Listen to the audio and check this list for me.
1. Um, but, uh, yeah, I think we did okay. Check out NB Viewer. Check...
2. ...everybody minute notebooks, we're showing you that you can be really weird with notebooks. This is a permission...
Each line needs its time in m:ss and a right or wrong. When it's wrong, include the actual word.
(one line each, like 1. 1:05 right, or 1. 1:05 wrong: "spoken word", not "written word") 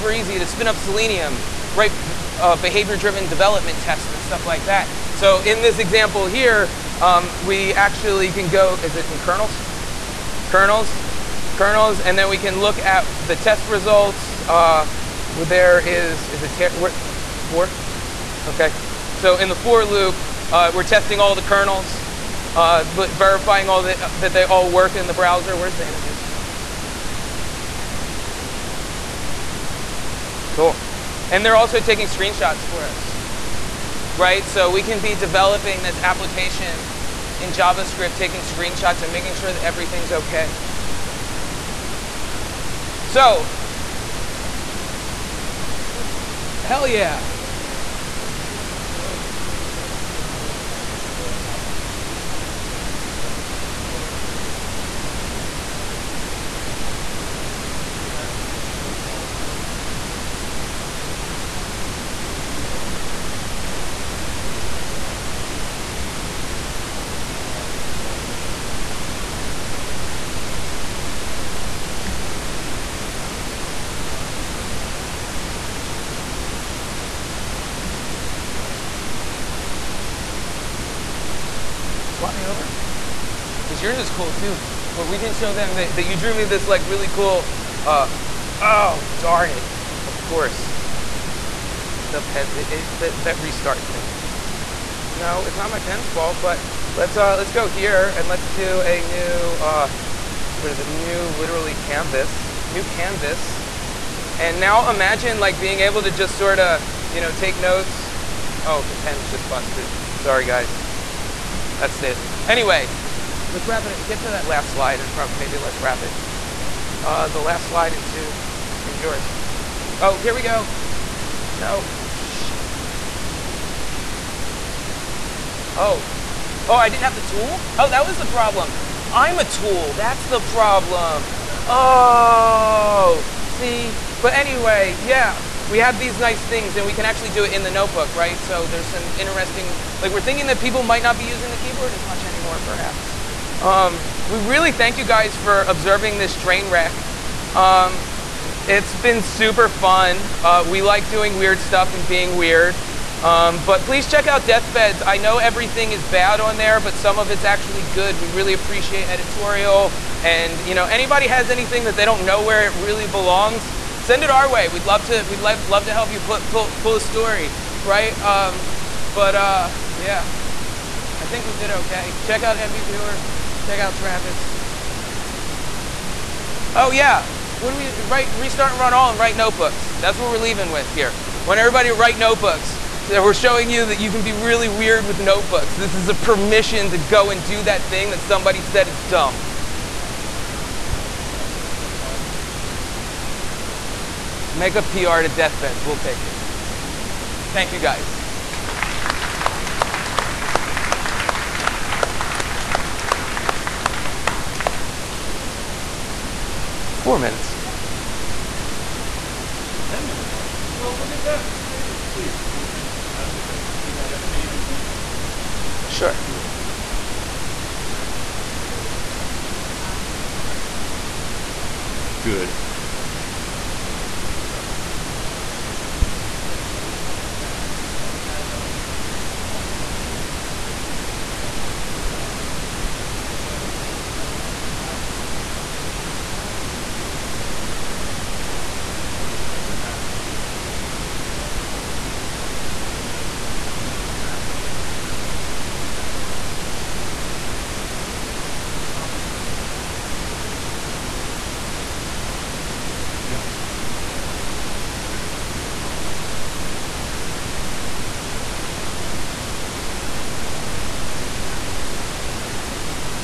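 1. 2:48 right
2. 3:01 wrong: "write", not "minute".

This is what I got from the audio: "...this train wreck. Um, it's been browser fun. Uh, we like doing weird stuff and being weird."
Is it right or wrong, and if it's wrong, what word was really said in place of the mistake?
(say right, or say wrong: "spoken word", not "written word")
wrong: "super", not "browser".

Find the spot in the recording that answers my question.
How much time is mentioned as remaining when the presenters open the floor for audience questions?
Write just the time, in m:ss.
3:27.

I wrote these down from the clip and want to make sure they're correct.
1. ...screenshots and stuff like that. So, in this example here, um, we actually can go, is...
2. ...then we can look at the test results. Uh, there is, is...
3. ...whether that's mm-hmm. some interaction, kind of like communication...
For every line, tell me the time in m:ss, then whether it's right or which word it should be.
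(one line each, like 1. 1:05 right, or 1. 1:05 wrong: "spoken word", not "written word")
1. 0:03 wrong: "tests", not "screenshots"
2. 0:12 right
3. 4:02 right.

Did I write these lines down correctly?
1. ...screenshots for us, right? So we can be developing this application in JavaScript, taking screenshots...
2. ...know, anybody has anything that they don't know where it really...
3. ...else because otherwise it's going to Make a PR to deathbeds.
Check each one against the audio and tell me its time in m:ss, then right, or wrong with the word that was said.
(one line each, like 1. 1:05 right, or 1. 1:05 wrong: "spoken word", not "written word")
1. 0:32 right
2. 2:40 right
3. 3:11 right.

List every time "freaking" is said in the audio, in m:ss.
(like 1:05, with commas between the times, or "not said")
not said.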